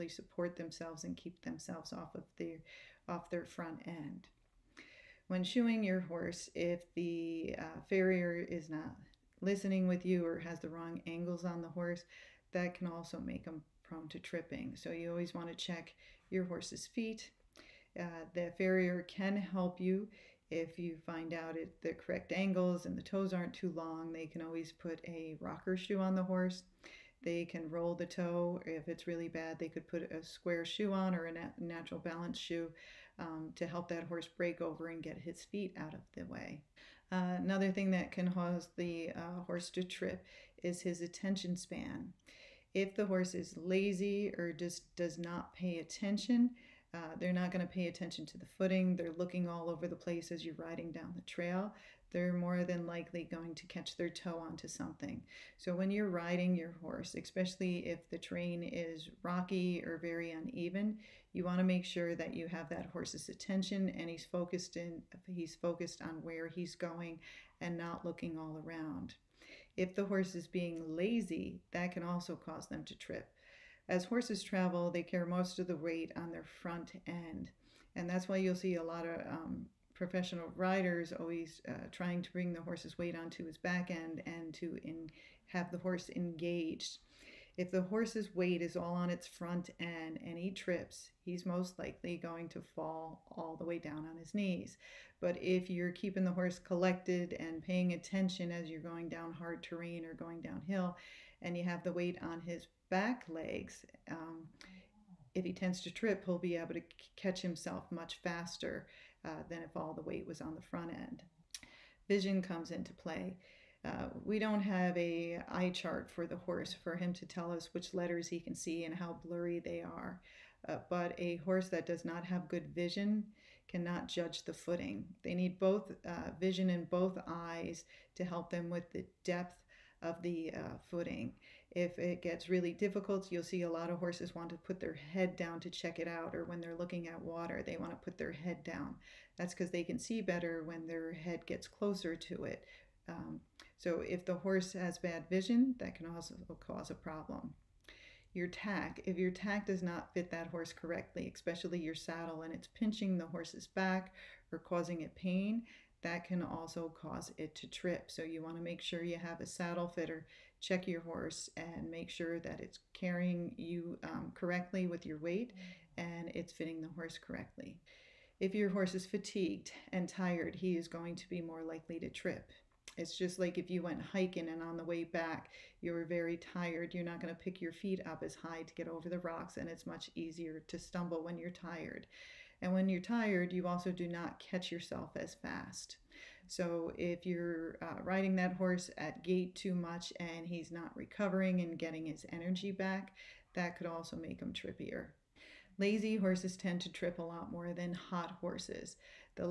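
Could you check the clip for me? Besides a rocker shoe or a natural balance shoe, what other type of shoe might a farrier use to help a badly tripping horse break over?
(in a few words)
Square shoe.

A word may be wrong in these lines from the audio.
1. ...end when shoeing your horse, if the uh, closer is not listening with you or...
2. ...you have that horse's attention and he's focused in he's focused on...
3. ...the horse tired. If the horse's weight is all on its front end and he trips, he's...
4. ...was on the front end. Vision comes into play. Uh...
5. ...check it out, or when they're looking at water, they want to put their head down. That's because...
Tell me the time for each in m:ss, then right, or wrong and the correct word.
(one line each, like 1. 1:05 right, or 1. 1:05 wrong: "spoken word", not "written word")
1. 0:03 wrong: "farrier", not "closer"
2. 1:02 right
3. 1:25 wrong: "engaged", not "tired"
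4. 1:50 right
5. 2:15 right.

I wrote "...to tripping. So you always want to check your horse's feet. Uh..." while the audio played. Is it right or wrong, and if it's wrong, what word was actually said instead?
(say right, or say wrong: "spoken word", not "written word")
right.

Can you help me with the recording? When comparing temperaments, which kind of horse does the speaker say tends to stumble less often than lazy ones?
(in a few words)
Hot horses.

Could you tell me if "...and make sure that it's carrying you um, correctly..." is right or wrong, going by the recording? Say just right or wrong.
right.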